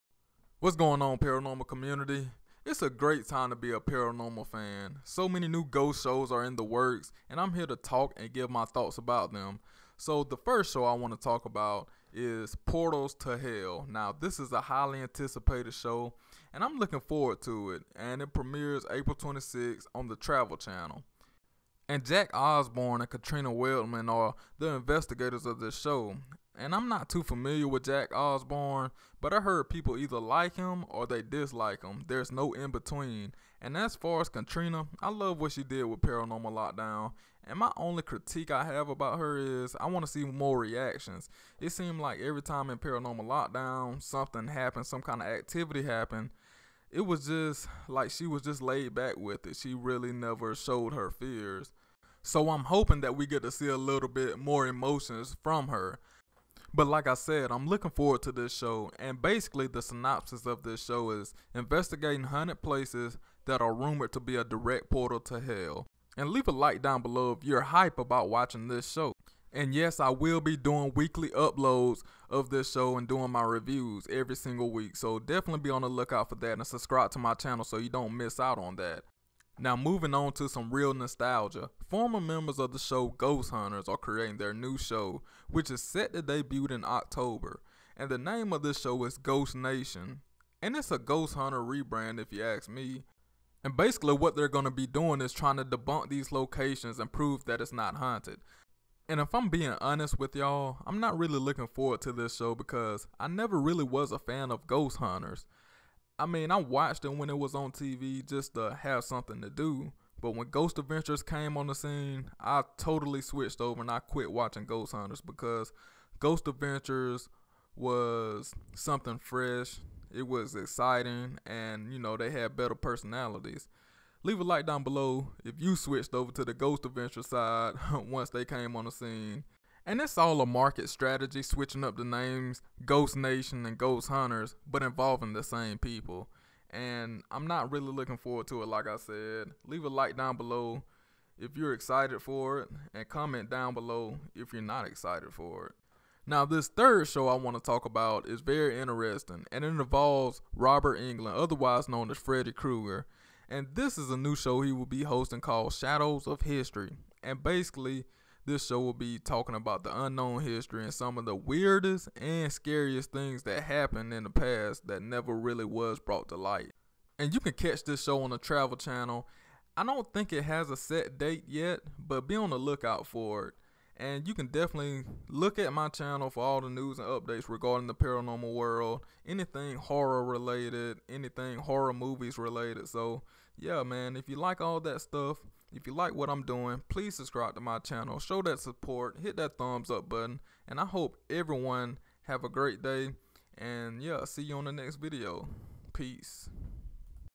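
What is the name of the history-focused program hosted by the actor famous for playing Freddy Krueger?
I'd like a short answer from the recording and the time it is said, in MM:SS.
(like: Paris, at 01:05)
Shadows of History, at 02:35.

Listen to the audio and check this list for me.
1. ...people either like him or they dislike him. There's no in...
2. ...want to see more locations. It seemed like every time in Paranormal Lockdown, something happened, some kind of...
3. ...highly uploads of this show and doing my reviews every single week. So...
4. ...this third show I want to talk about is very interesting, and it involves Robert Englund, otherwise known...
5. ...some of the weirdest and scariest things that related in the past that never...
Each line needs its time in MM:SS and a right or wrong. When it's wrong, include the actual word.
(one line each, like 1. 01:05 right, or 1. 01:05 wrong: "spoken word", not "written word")
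1. 00:29 right
2. 00:39 wrong: "reactions", not "locations"
3. 01:10 wrong: "weekly", not "highly"
4. 02:26 right
5. 02:40 wrong: "happened", not "related".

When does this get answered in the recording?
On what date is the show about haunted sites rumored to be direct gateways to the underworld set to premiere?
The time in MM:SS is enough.
00:18.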